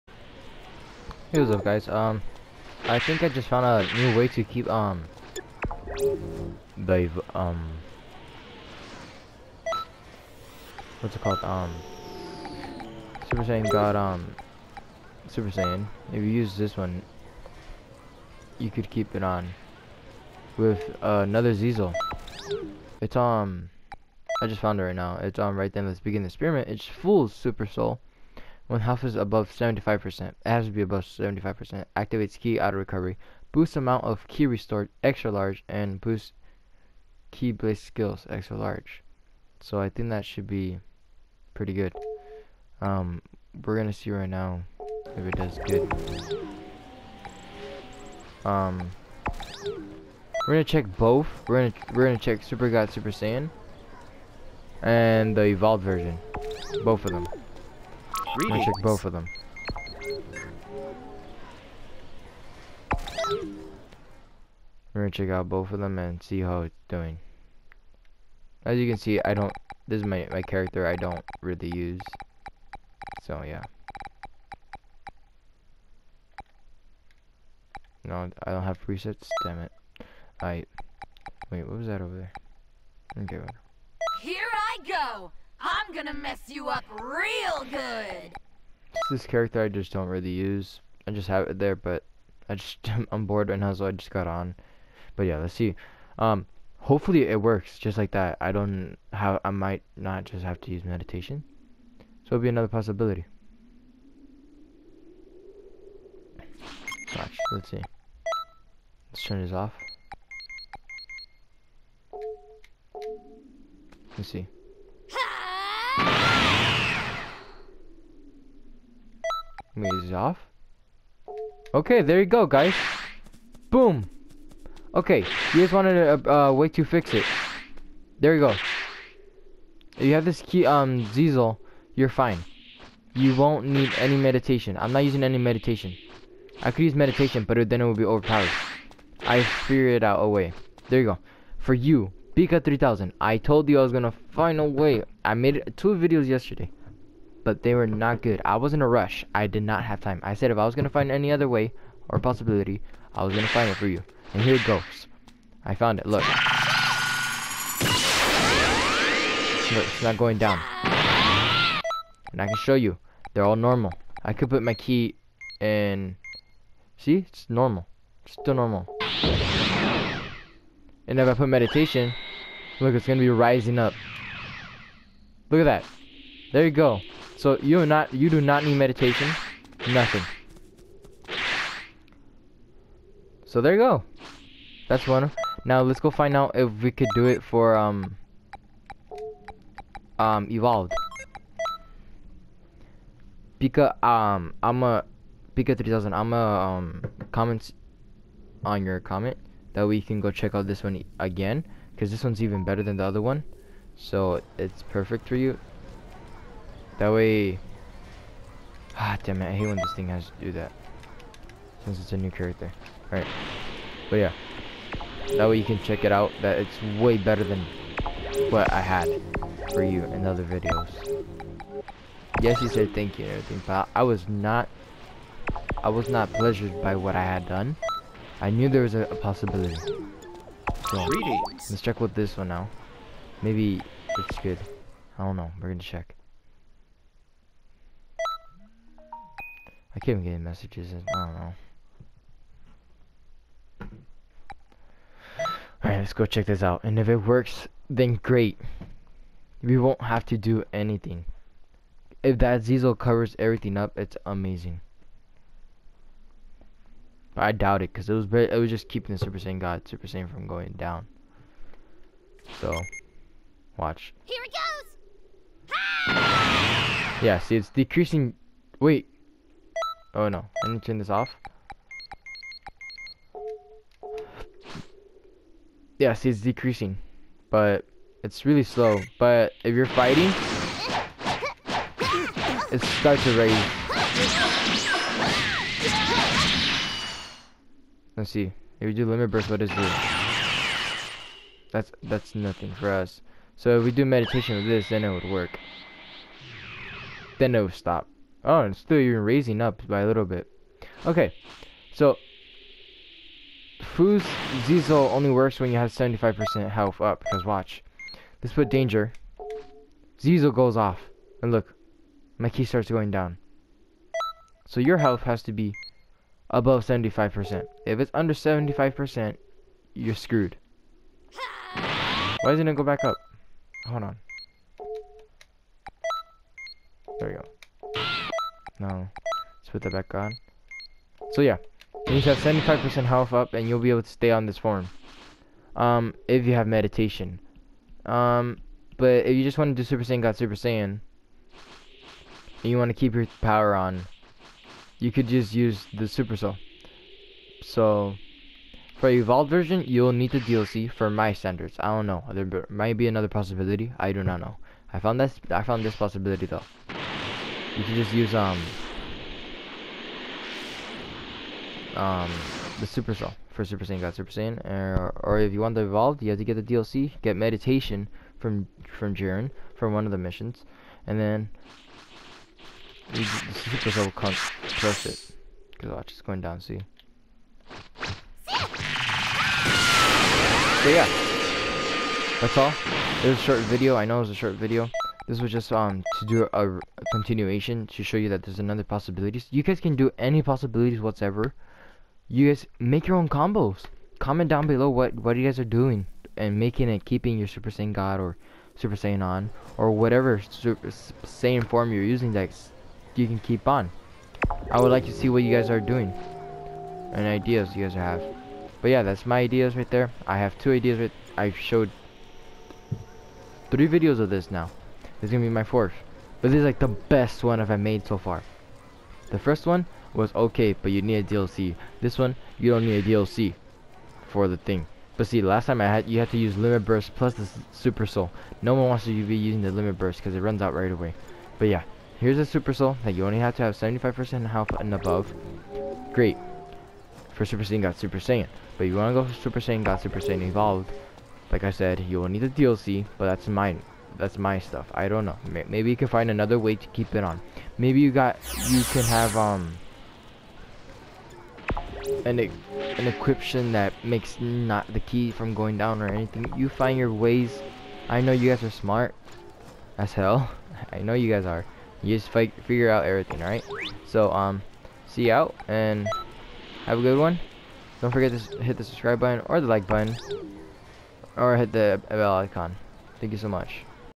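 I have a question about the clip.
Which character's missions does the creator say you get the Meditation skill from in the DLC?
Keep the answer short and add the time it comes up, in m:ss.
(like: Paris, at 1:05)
Jiren, at 6:09.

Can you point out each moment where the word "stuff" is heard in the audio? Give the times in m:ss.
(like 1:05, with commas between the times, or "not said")
7:24.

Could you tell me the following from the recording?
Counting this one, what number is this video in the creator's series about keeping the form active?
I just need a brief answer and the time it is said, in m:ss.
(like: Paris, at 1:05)
4, at 6:55.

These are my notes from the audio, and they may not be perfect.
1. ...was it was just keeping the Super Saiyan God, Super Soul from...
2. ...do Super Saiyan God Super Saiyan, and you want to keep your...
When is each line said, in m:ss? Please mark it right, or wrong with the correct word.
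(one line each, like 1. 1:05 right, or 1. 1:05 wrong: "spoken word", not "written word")
1. 4:18 wrong: "Saiyan", not "Soul"
2. 5:39 right.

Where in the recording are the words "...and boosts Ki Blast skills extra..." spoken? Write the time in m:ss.
0:35.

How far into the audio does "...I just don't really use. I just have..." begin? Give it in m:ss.
1:29.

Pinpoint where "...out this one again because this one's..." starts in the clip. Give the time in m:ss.
3:20.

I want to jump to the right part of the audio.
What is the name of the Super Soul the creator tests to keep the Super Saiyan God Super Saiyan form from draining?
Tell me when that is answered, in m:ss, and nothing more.
0:26.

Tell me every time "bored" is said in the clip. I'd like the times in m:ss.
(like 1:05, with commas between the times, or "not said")
1:33.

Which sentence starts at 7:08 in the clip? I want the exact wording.
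No one wants to be using the Limit Burst because it runs out right away.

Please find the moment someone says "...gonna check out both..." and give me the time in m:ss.
1:05.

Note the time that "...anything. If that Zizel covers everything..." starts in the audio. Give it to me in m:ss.
4:10.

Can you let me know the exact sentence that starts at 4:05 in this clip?
Alright, let's go check this out.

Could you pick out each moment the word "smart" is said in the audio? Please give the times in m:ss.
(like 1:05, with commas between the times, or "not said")
7:38.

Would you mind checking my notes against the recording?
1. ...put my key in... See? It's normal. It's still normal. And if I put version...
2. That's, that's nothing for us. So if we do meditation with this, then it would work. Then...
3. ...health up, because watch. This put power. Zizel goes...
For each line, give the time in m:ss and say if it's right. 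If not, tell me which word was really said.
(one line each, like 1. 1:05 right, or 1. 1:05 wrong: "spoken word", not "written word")
1. 2:44 wrong: "meditation", not "version"
2. 4:51 right
3. 5:06 wrong: "danger", not "power".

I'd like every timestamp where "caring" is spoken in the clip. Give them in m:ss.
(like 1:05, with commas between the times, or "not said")
not said.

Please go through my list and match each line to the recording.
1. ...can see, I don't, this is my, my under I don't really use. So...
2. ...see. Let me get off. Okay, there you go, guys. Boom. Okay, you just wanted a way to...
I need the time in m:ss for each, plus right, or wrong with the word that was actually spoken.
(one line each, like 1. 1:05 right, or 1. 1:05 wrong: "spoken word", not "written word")
1. 1:08 wrong: "character", not "under"
2. 1:54 right.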